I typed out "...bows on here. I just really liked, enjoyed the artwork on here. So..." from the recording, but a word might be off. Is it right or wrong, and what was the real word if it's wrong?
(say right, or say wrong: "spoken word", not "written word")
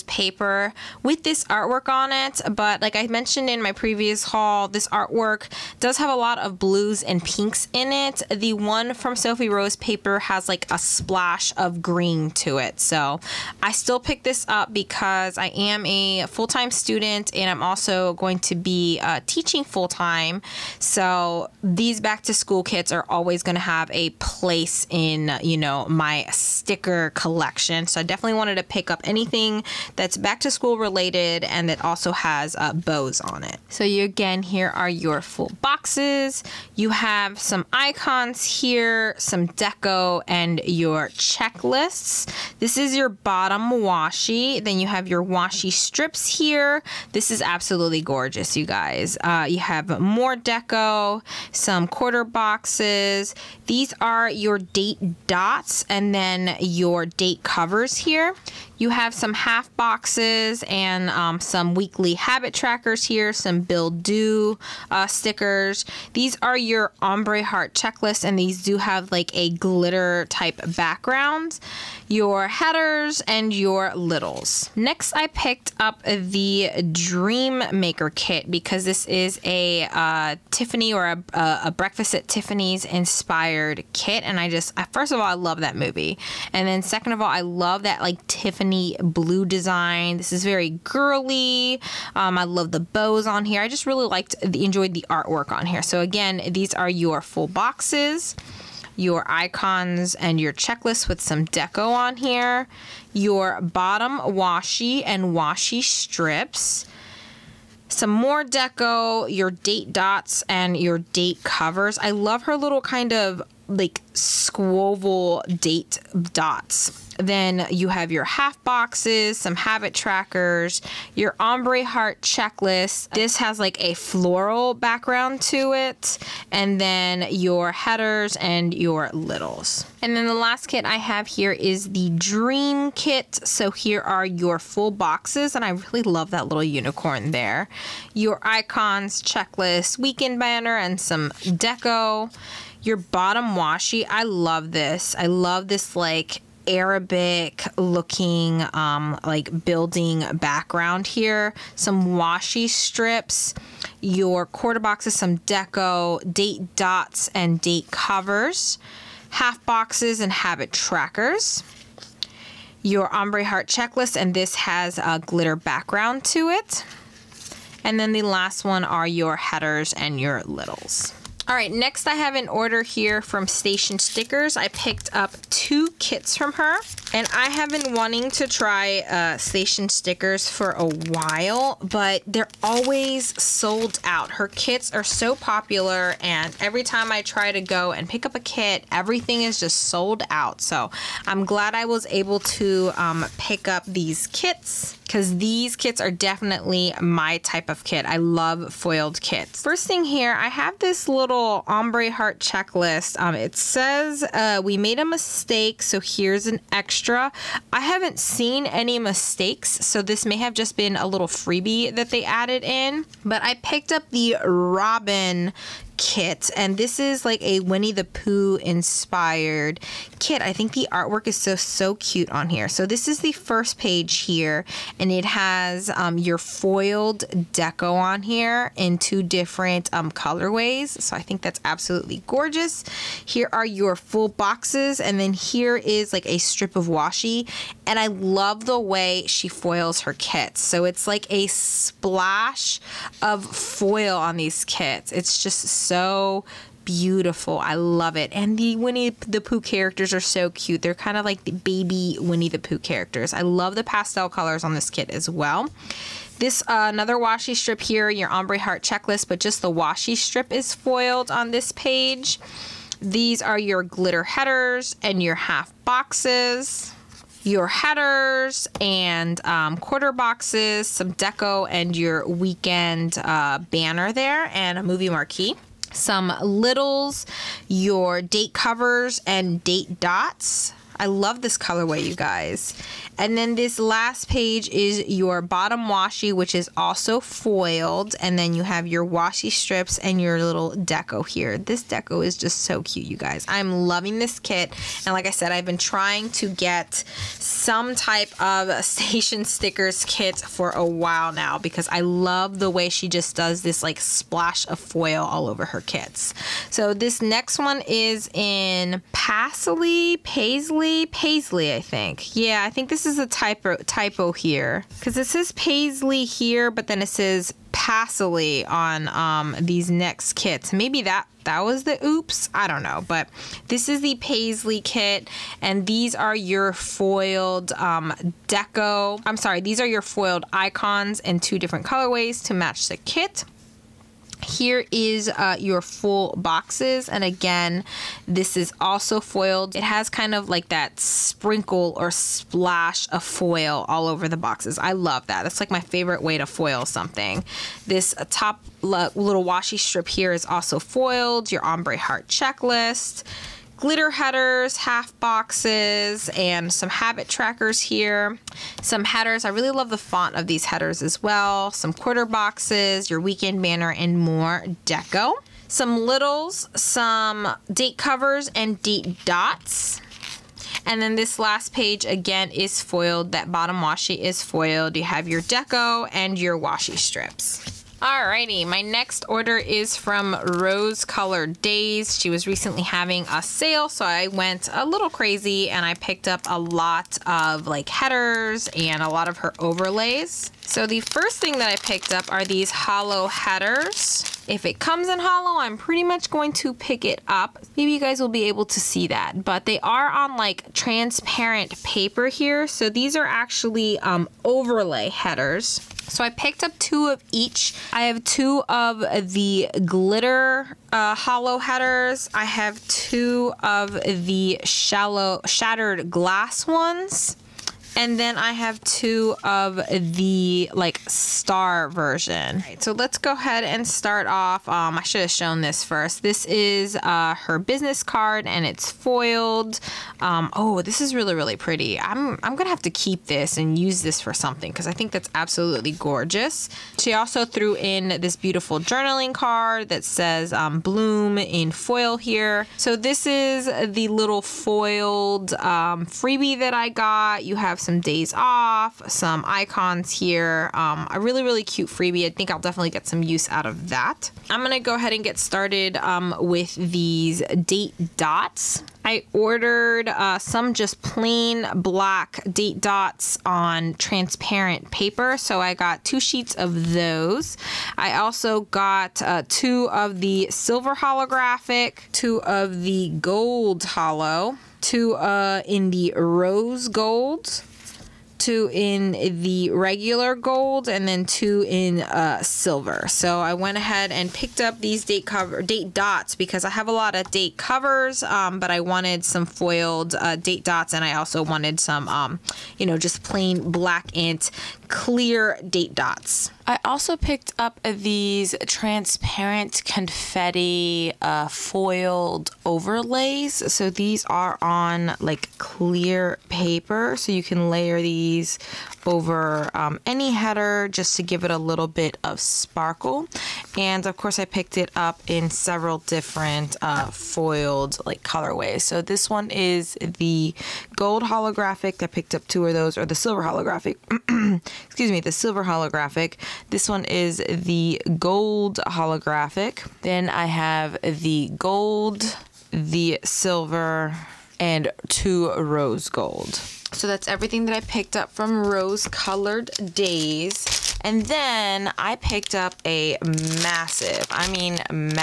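right.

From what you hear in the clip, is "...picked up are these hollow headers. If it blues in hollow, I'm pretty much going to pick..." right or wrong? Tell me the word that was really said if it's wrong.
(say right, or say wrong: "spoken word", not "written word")
wrong: "comes", not "blues".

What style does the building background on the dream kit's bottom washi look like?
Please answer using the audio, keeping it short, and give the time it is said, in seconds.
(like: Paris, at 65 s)
Arabic, at 146 s.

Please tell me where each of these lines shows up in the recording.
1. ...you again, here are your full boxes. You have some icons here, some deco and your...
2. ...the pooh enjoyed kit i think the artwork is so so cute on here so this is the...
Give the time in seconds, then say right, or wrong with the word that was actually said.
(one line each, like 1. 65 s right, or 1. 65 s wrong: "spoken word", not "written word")
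1. 33 s right
2. 217 s wrong: "inspired", not "enjoyed".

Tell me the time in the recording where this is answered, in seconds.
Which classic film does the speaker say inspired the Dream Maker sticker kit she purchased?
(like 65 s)
81 s.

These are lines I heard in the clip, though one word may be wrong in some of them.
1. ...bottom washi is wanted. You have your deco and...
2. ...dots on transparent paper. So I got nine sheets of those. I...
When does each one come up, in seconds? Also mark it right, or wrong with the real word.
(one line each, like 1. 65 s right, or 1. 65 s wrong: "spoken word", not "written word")
1. 373 s wrong: "foiled", not "wanted"
2. 462 s wrong: "two", not "nine".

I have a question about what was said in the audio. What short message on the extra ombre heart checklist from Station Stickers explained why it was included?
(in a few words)
we made a mistake.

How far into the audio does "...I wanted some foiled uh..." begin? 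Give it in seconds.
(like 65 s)
488 s.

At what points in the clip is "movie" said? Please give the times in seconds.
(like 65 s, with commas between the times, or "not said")
85 s, 274 s.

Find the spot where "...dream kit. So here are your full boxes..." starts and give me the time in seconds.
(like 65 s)
132 s.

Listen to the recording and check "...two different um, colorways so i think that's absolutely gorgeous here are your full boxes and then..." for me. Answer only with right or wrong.
right.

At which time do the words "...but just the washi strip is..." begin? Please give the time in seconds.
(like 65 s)
259 s.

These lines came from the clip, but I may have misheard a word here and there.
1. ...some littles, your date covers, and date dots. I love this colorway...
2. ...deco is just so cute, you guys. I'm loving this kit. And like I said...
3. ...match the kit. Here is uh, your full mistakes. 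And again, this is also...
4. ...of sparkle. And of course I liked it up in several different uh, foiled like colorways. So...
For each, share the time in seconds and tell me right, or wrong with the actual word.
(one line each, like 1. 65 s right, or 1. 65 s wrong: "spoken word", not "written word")
1. 275 s right
2. 291 s right
3. 332 s wrong: "boxes", not "mistakes"
4. 512 s wrong: "picked", not "liked".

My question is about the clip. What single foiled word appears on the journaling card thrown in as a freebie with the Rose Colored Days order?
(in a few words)
Bloom.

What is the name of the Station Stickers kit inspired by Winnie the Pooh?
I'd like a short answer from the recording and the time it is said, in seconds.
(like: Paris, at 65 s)
Robin, at 214 s.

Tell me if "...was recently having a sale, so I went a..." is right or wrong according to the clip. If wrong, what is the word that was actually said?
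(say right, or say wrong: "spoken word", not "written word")
right.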